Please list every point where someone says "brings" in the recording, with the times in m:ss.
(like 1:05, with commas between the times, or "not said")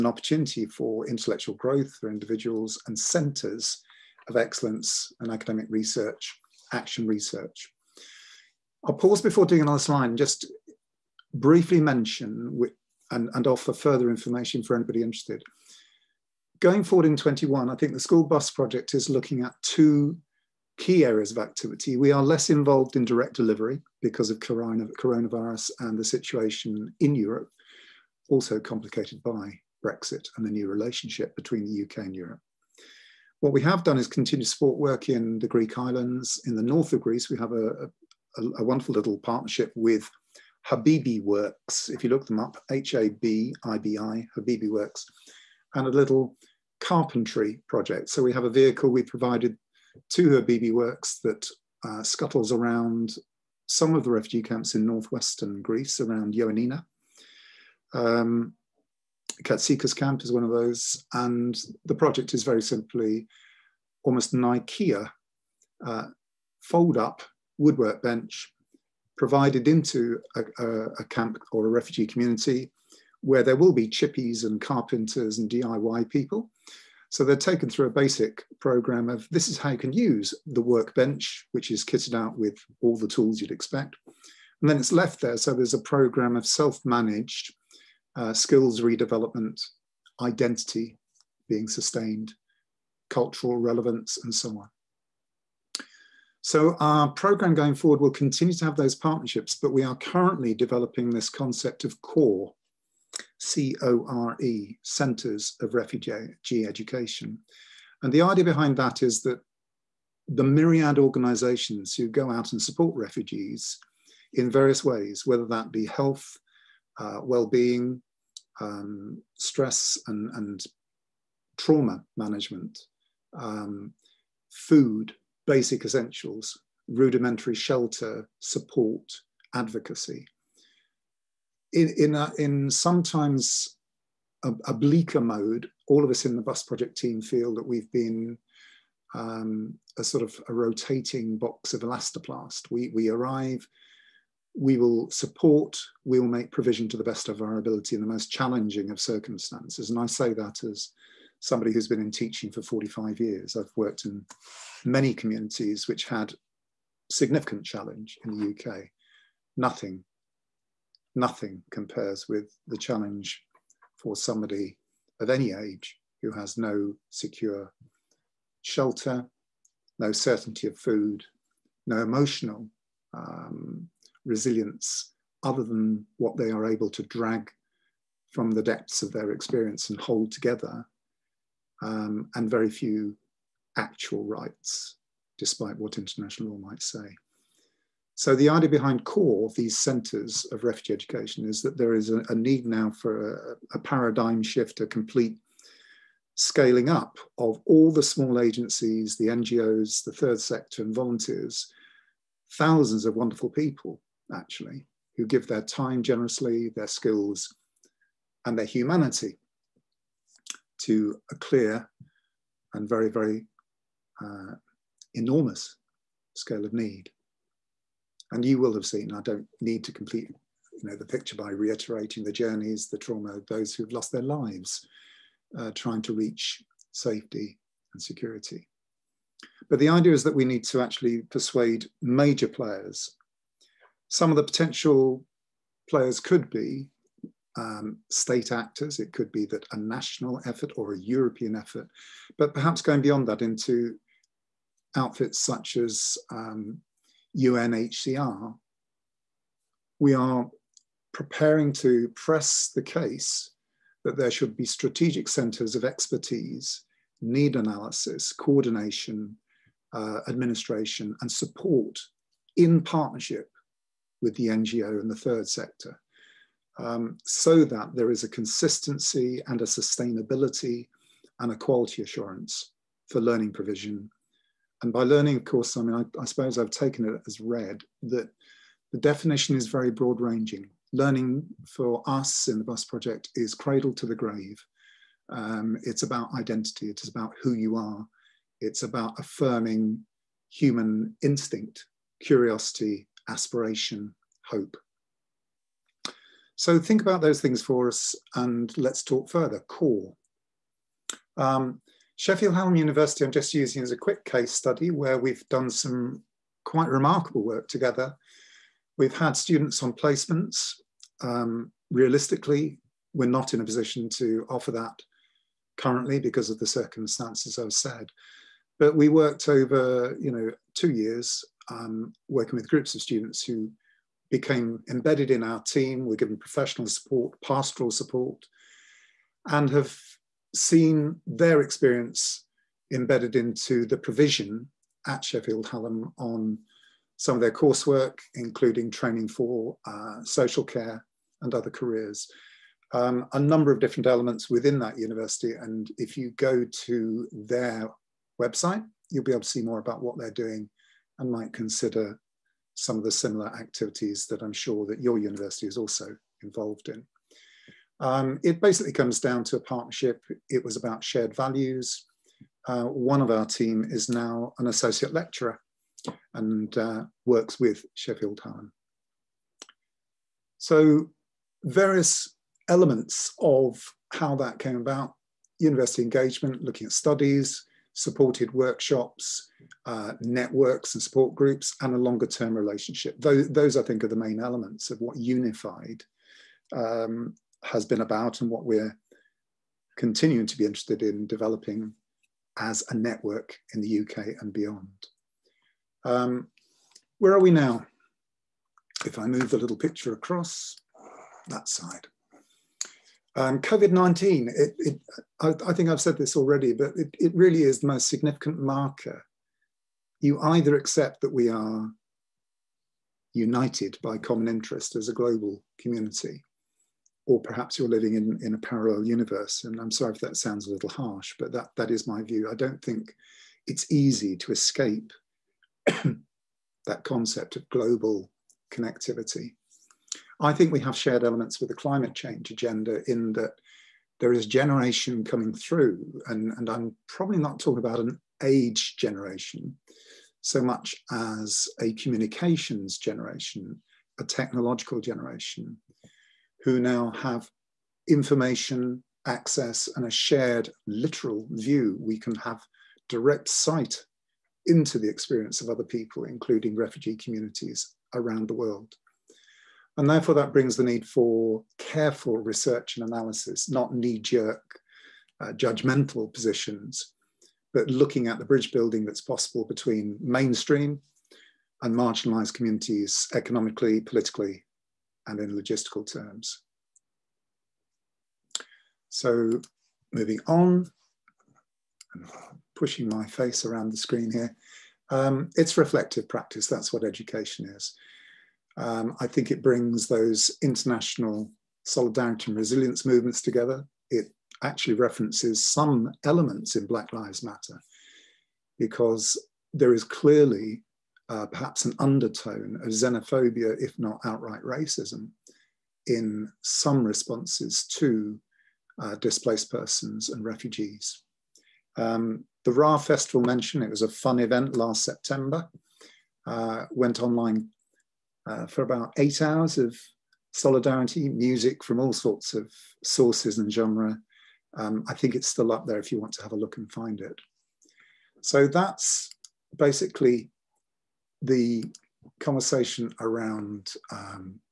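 7:40, 8:09.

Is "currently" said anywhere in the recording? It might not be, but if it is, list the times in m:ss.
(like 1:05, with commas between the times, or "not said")
1:39, 5:15.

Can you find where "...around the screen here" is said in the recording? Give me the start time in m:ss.
8:03.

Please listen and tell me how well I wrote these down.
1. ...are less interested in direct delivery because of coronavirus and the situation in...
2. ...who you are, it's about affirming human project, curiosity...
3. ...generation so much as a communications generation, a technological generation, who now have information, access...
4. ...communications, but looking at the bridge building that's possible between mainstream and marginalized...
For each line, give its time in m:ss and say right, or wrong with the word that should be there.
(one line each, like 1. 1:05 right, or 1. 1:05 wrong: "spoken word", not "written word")
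1. 0:22 wrong: "involved", not "interested"
2. 4:47 wrong: "instinct", not "project"
3. 7:18 right
4. 7:46 wrong: "positions", not "communications".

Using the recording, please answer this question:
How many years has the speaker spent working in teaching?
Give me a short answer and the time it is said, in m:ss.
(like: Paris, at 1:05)
45, at 2:32.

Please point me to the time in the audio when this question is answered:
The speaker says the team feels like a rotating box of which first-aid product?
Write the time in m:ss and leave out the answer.
2:21.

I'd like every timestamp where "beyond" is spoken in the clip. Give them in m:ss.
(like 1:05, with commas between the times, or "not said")
4:03, 6:34.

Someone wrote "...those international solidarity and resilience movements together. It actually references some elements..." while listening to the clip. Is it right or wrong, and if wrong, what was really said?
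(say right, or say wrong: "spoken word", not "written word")
right.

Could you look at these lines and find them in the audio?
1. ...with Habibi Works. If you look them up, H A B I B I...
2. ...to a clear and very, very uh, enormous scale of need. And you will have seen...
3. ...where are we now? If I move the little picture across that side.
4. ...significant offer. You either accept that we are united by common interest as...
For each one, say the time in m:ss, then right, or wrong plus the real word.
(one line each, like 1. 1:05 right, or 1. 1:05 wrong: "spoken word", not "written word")
1. 0:39 right
2. 3:30 right
3. 6:37 right
4. 6:48 wrong: "marker", not "offer".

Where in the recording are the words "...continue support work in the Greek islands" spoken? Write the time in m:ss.
0:34.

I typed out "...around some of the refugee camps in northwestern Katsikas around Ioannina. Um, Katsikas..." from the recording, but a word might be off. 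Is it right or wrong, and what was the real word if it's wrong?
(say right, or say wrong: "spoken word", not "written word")
wrong: "Greece", not "Katsikas".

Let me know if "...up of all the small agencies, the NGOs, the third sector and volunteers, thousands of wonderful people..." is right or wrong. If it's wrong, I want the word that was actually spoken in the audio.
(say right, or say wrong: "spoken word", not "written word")
right.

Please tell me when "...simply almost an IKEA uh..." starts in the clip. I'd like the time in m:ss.
1:02.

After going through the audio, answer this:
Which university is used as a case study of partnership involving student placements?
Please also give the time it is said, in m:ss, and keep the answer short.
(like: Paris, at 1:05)
Sheffield Hallam University, at 5:02.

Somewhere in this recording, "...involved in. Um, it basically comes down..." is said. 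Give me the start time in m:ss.
5:56.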